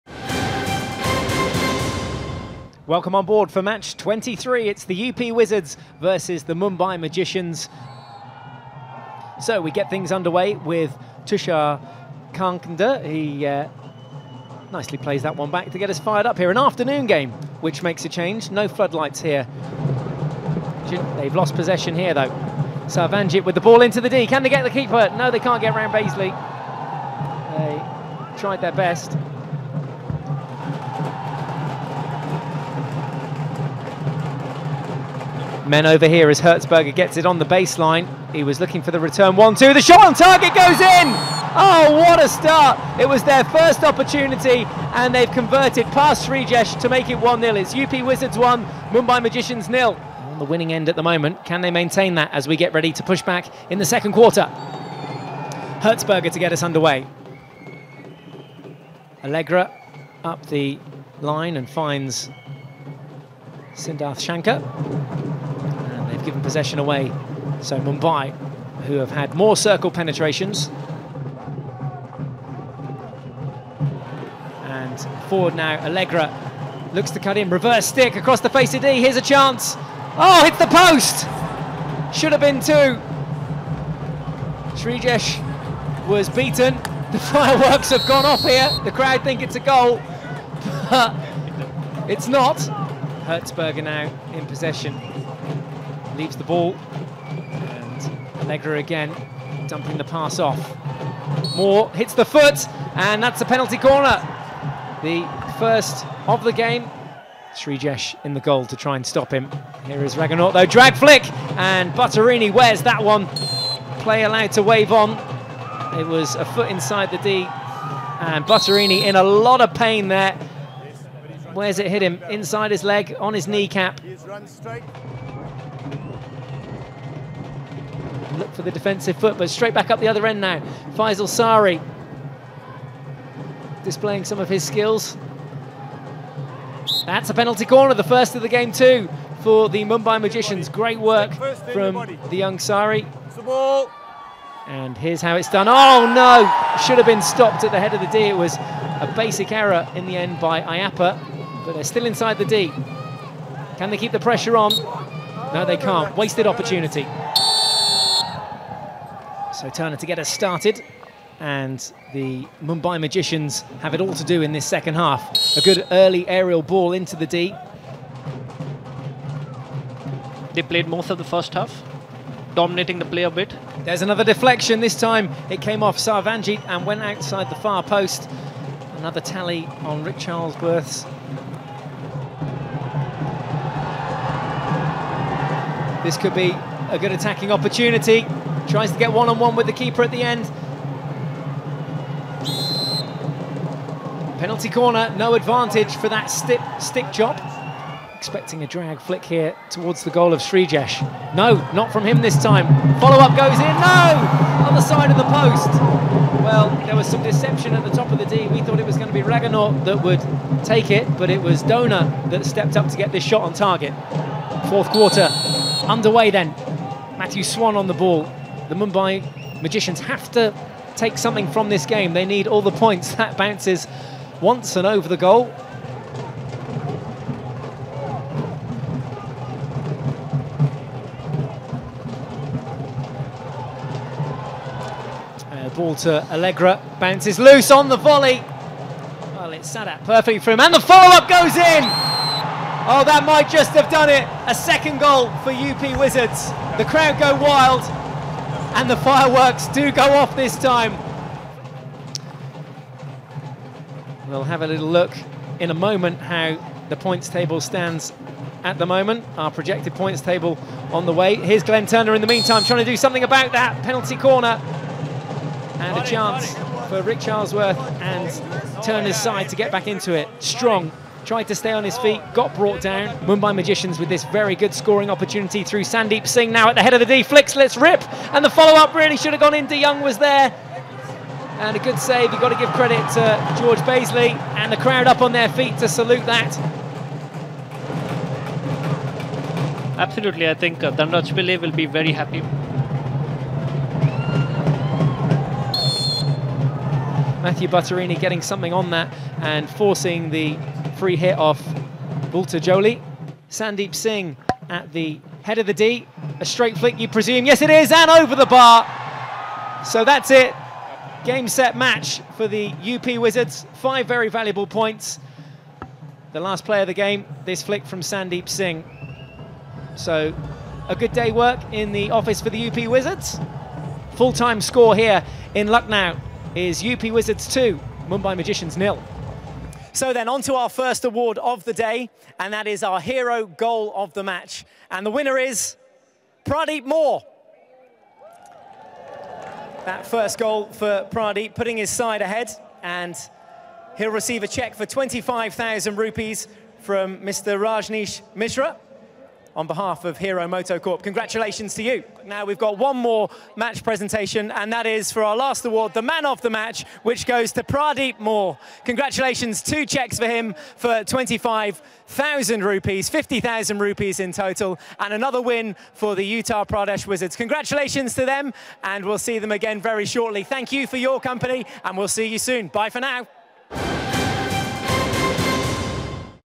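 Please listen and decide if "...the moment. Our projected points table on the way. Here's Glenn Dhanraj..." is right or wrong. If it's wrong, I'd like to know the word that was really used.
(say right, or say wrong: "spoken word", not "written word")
wrong: "Turner", not "Dhanraj".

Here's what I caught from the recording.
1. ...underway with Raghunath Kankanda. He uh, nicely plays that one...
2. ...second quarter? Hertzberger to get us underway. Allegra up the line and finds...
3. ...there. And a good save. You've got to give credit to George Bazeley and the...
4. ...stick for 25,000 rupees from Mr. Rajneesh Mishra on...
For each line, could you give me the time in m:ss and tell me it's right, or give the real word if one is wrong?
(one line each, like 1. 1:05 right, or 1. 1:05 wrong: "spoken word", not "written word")
1. 0:10 wrong: "Tushar", not "Raghunath"
2. 0:53 right
3. 4:40 right
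4. 5:44 wrong: "check", not "stick".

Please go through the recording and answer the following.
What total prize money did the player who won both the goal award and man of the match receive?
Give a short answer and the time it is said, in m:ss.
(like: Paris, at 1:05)
50,000 rupees, at 6:03.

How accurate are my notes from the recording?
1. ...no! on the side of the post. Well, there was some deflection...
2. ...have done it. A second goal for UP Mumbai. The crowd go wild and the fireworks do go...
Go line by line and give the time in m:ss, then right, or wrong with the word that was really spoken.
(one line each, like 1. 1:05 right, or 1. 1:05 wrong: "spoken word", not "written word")
1. 3:23 wrong: "deception", not "deflection"
2. 4:03 wrong: "Wizards", not "Mumbai".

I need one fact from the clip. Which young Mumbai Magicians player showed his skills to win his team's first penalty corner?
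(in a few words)
Faizal Saari.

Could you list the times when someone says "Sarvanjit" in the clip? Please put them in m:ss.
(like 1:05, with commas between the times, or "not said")
0:22, 2:55.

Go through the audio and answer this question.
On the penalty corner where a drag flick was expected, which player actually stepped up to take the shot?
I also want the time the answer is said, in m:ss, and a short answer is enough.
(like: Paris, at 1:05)
Dona, at 3:31.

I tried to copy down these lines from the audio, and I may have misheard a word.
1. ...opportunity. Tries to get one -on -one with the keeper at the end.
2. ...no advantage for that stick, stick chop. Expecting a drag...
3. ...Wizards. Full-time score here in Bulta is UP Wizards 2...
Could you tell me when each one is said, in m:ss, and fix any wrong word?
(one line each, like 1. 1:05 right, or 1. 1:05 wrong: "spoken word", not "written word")
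1. 3:07 right
2. 3:15 right
3. 5:22 wrong: "Lucknow", not "Bulta".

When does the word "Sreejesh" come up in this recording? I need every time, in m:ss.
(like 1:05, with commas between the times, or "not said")
0:46, 1:24, 1:47, 3:20.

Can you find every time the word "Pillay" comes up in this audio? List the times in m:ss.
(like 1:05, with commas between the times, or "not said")
4:51.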